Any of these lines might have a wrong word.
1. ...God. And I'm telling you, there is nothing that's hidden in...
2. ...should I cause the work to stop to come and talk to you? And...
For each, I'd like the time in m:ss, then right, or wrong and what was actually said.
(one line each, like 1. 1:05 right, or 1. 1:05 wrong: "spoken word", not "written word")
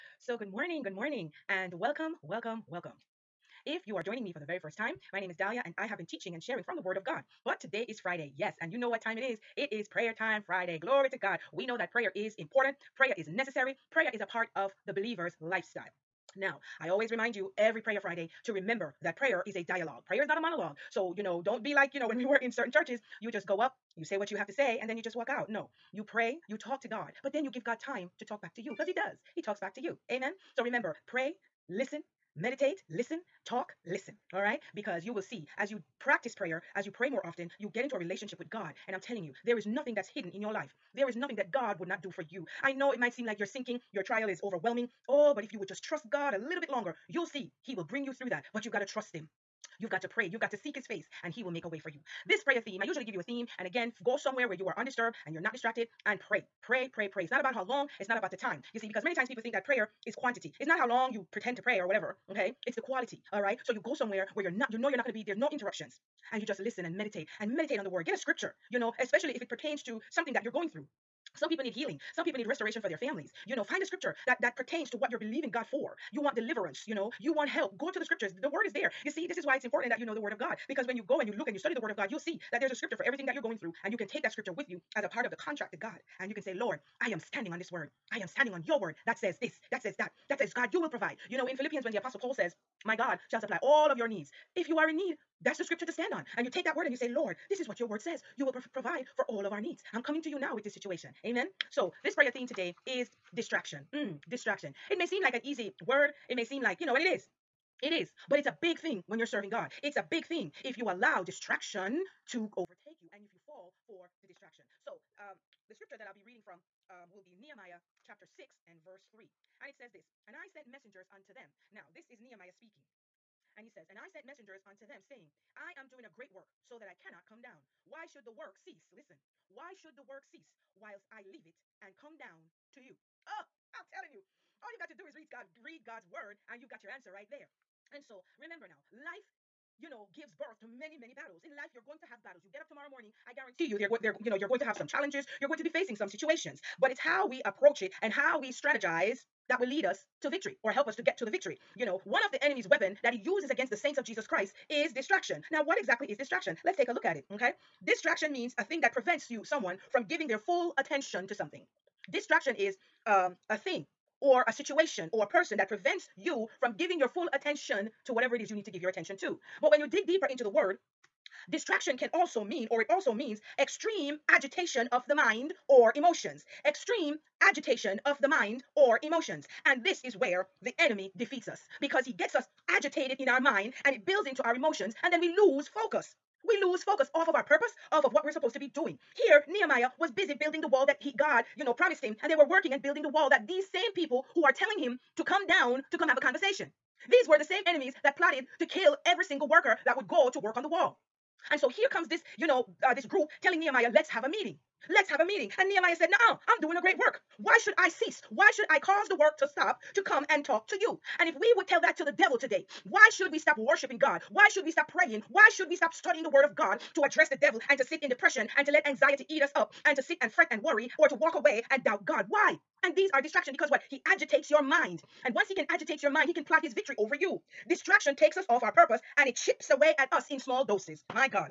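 1. 0:38 right
2. 3:28 right.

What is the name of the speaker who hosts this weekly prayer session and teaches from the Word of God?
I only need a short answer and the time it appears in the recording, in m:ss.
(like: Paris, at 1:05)
Dahlia, at 0:05.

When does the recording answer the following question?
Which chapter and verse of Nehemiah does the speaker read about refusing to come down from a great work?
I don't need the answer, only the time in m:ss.
1:58.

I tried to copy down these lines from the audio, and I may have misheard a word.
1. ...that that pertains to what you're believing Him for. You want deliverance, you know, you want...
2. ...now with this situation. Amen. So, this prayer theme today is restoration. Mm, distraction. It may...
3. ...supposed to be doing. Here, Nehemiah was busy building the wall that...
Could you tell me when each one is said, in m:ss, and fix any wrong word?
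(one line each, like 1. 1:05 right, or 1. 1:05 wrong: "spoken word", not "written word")
1. 1:14 wrong: "God", not "Him"
2. 1:40 wrong: "distraction", not "restoration"
3. 3:08 right.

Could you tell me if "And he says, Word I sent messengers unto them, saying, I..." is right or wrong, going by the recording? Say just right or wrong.
wrong.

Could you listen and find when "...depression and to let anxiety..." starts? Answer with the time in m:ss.
3:38.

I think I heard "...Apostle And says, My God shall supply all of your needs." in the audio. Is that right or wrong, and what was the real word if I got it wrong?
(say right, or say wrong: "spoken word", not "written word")
wrong: "Paul", not "And".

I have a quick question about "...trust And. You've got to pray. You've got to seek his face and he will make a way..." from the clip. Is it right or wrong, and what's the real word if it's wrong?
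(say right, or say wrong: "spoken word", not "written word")
wrong: "Him", not "And".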